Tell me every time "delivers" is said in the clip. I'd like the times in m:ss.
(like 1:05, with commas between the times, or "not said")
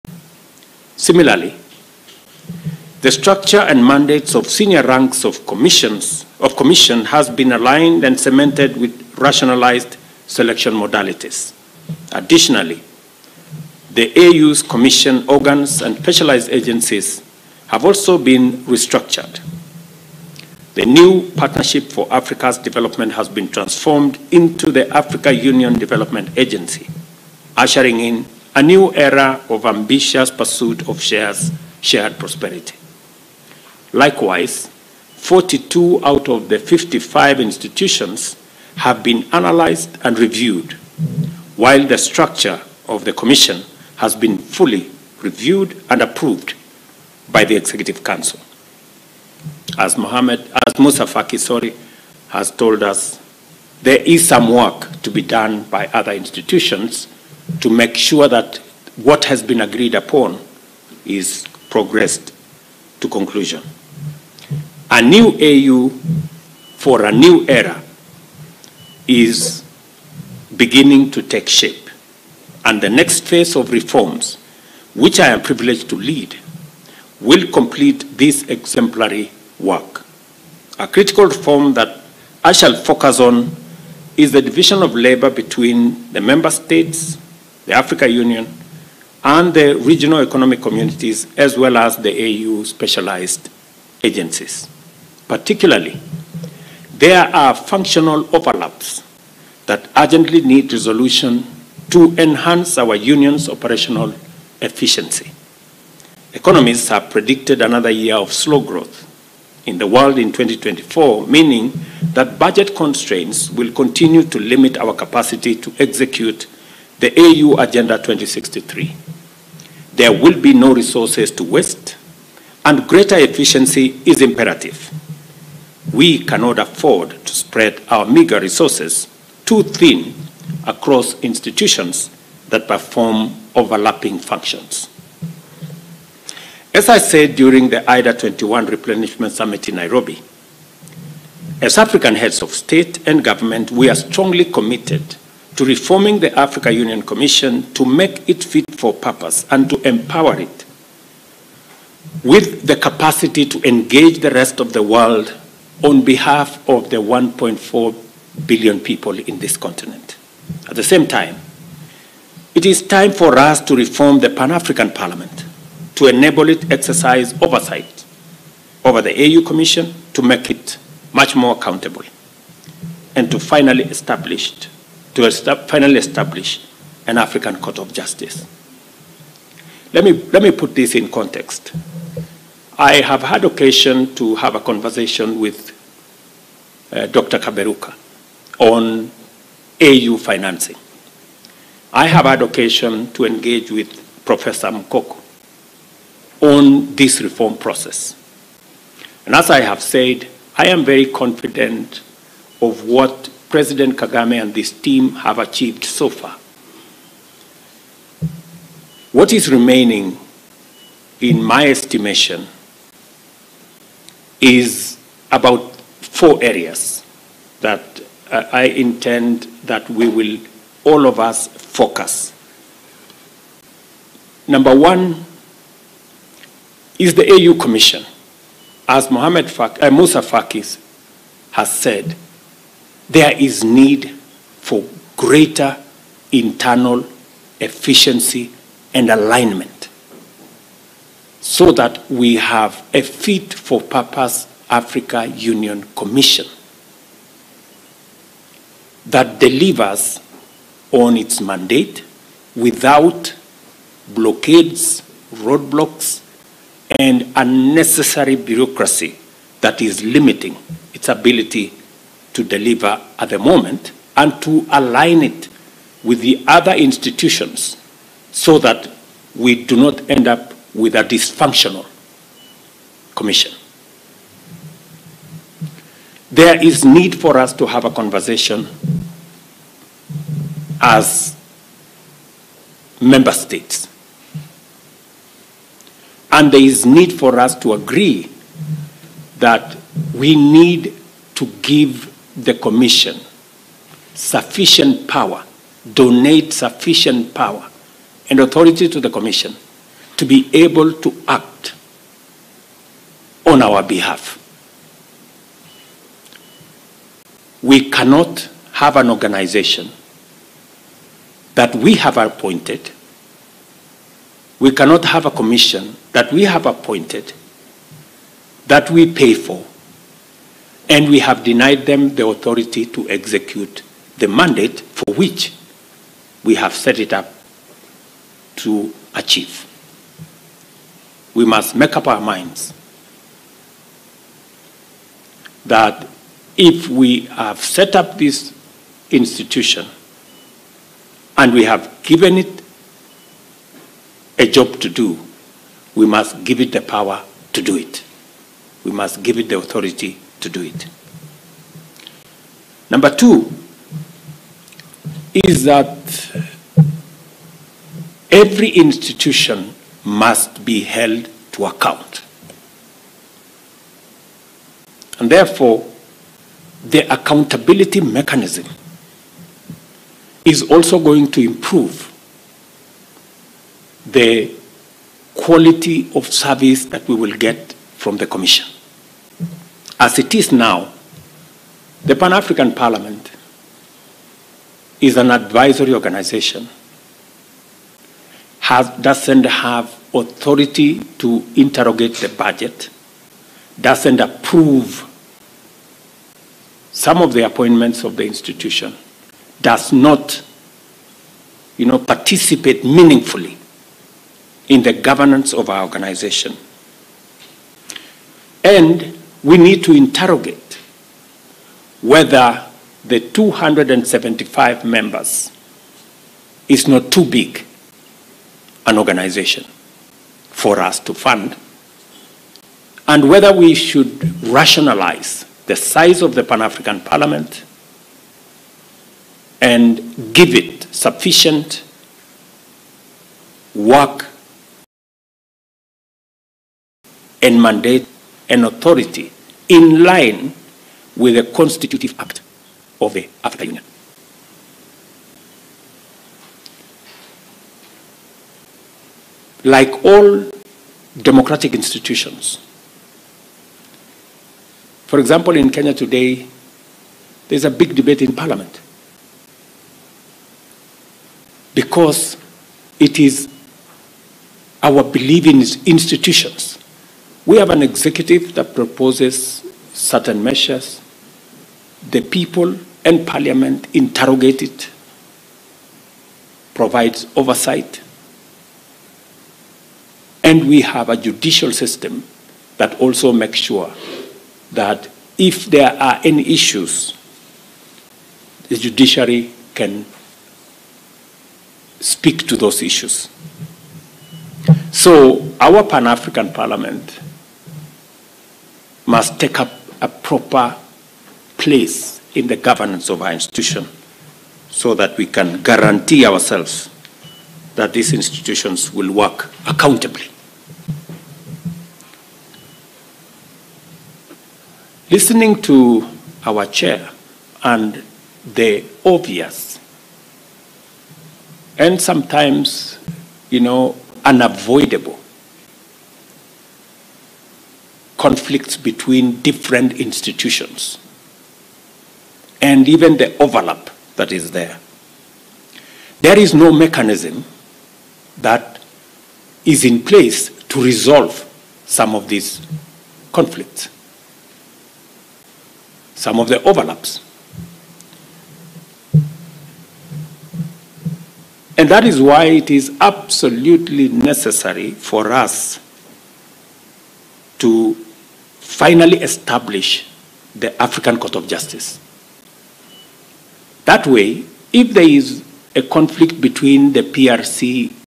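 4:09, 4:22.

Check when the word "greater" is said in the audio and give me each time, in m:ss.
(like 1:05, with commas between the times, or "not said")
2:02, 3:55.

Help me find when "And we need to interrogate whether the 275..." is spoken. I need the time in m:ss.
6:48.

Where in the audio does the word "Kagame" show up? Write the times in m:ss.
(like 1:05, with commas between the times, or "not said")
3:23.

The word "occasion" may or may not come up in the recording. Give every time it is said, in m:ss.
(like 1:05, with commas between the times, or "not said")
3:03, 3:12.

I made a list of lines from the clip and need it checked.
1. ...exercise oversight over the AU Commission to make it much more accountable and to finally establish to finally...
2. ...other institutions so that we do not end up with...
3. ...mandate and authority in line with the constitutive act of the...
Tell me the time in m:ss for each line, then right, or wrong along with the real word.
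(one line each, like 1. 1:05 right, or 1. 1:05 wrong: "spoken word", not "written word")
1. 2:46 right
2. 4:26 right
3. 7:17 right.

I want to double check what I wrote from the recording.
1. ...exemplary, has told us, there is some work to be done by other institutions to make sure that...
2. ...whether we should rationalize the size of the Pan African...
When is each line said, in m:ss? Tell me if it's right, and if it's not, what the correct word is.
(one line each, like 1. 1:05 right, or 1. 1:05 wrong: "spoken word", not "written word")
1. 0:51 wrong: "sorry", not "exemplary"
2. 7:03 right.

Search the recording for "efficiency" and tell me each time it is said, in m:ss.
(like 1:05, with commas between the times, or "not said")
1:44, 2:03, 3:57.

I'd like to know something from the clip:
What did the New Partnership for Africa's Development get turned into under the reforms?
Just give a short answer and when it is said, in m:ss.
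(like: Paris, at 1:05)
Africa Union Development Agency, at 0:24.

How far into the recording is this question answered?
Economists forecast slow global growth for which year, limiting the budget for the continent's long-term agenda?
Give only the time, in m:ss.
1:50.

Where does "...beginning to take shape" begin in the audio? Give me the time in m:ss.
1:10.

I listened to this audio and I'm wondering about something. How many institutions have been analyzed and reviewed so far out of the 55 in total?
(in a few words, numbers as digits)
42.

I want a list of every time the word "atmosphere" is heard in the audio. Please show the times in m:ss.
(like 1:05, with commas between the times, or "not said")
not said.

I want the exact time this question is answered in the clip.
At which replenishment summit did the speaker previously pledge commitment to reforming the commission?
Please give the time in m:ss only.
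2:17.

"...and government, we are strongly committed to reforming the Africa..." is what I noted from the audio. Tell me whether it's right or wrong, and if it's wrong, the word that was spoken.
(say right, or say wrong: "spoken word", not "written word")
right.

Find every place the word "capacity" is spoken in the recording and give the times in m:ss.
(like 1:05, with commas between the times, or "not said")
1:54, 2:32.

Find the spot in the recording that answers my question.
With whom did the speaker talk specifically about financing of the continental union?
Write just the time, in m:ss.
3:07.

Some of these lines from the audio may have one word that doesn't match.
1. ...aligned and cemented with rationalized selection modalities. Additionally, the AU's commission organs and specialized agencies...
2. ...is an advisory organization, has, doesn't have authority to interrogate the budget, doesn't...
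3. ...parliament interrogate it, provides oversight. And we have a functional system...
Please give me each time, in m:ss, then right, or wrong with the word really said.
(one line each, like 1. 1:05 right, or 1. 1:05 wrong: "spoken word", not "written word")
1. 0:07 right
2. 6:24 right
3. 7:53 wrong: "judicial", not "functional".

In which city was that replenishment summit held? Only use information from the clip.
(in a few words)
Nairobi.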